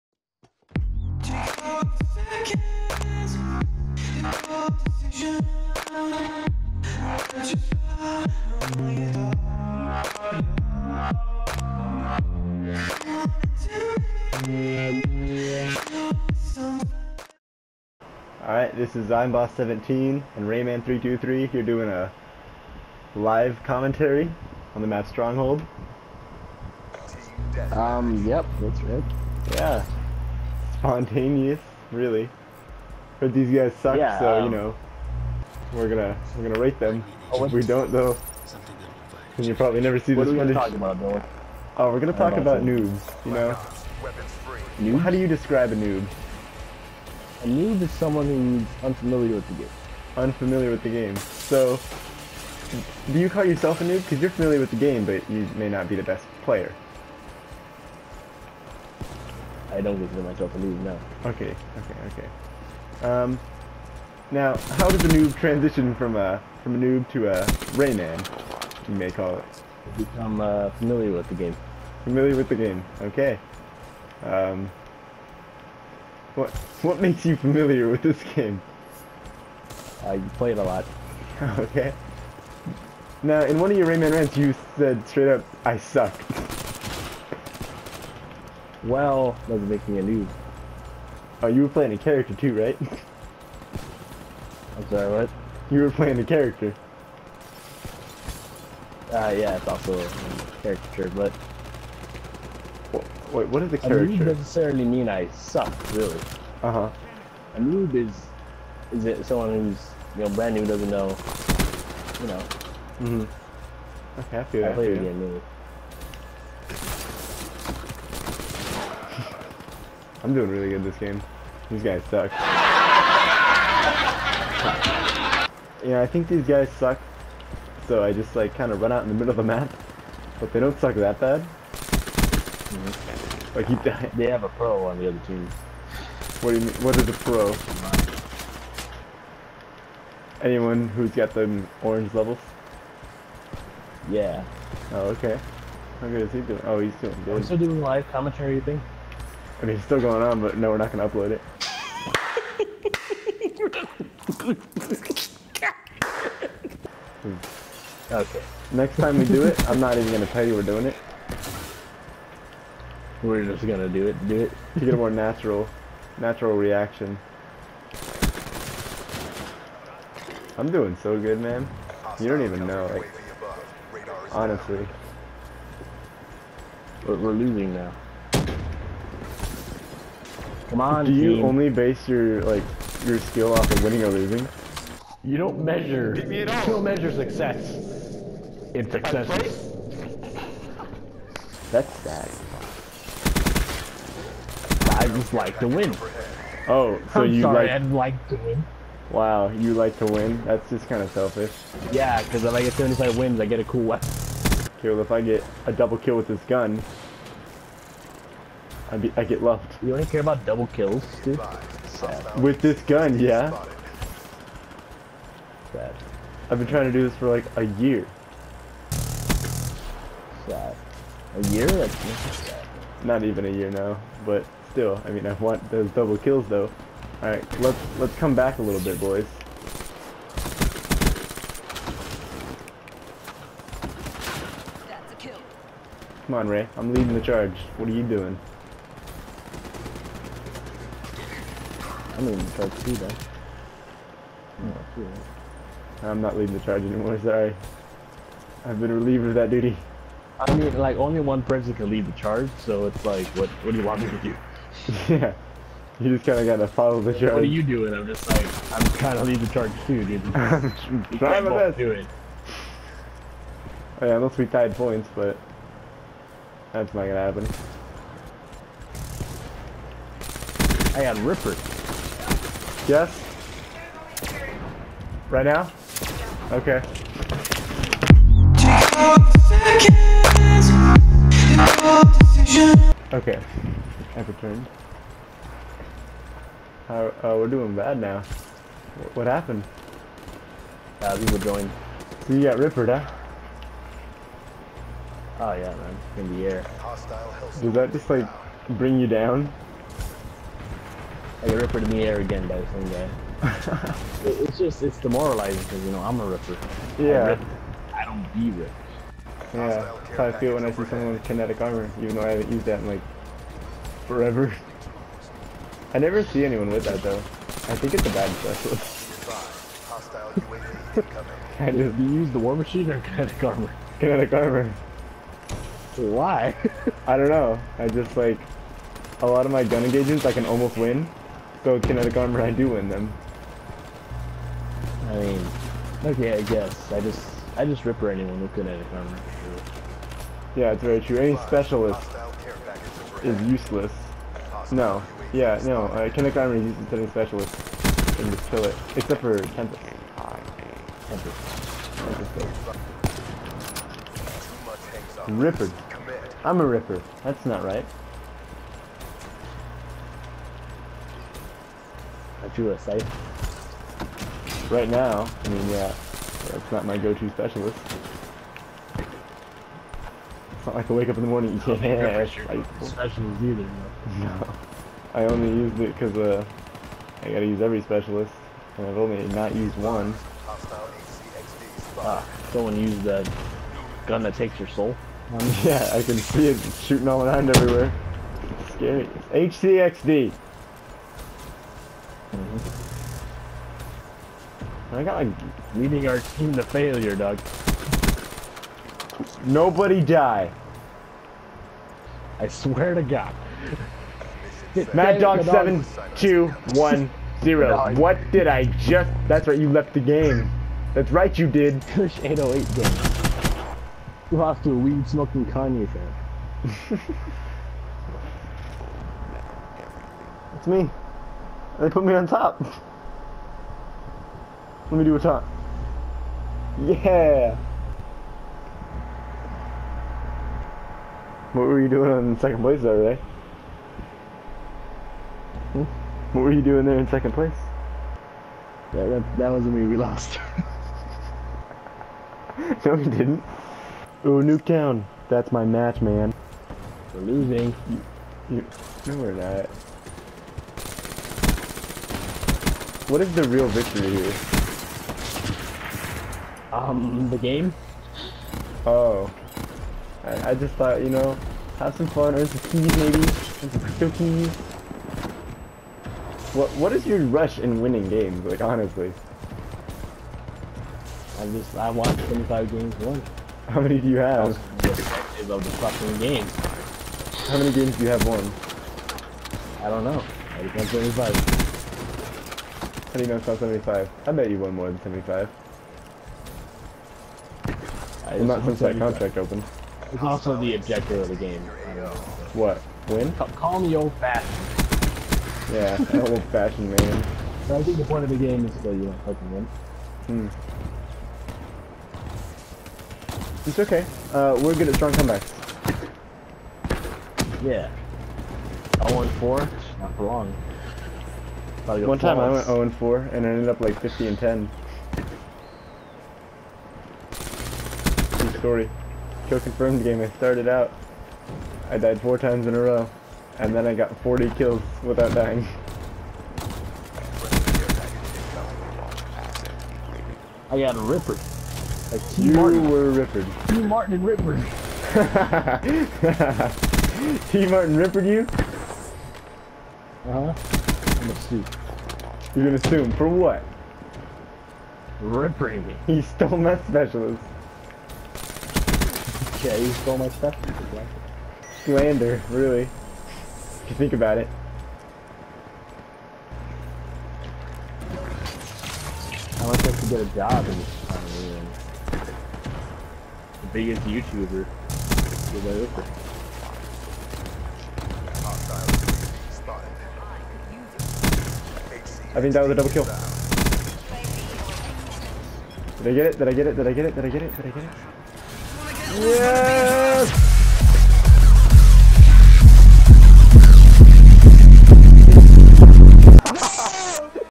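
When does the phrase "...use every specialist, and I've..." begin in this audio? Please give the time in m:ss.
6:17.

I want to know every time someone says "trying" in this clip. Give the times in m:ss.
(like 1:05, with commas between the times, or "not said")
3:36, 4:21.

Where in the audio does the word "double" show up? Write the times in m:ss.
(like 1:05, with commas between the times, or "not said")
3:25, 3:30, 3:45, 9:32.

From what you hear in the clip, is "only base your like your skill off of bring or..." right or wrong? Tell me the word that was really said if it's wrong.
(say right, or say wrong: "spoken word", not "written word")
wrong: "winning", not "bring".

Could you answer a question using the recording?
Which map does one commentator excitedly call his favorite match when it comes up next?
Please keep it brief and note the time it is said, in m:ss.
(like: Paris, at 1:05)
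Nuketown, at 7:24.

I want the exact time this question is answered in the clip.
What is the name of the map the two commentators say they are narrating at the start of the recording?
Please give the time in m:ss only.
0:25.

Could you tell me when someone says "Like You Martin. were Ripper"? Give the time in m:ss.
8:52.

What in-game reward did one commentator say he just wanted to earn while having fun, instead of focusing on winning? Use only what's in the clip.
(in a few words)
Crypto keys.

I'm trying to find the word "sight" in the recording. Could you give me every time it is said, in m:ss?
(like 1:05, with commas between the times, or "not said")
not said.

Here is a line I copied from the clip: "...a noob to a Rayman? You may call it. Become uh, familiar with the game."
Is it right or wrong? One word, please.
right.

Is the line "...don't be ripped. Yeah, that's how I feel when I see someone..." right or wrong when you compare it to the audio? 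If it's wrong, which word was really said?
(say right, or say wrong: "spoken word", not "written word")
right.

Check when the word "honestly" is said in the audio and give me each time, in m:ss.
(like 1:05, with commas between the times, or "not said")
2:54, 7:48.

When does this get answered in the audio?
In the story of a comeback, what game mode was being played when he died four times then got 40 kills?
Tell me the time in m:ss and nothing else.
8:39.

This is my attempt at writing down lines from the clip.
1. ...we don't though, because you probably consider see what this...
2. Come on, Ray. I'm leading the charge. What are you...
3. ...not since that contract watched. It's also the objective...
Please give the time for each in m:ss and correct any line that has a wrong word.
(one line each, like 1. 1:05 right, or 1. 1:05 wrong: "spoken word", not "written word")
1. 0:37 wrong: "never", not "consider"
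2. 3:56 right
3. 8:08 wrong: "opened", not "watched".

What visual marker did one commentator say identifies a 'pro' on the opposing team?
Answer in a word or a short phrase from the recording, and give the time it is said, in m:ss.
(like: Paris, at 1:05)
Orange levels, at 2:21.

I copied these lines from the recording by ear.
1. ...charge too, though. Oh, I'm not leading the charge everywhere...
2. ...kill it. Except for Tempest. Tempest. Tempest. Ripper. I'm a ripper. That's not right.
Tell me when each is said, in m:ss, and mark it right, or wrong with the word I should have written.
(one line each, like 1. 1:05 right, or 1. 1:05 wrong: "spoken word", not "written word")
1. 4:02 wrong: "anymore", not "everywhere"
2. 5:48 right.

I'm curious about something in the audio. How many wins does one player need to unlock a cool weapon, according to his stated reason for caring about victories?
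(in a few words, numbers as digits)
75.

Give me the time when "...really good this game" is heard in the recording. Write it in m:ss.
2:00.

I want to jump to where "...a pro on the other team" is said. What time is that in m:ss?
2:14.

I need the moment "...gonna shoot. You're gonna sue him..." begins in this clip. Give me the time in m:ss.
9:01.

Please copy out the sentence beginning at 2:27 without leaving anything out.
I'm still doing live commentary, you think?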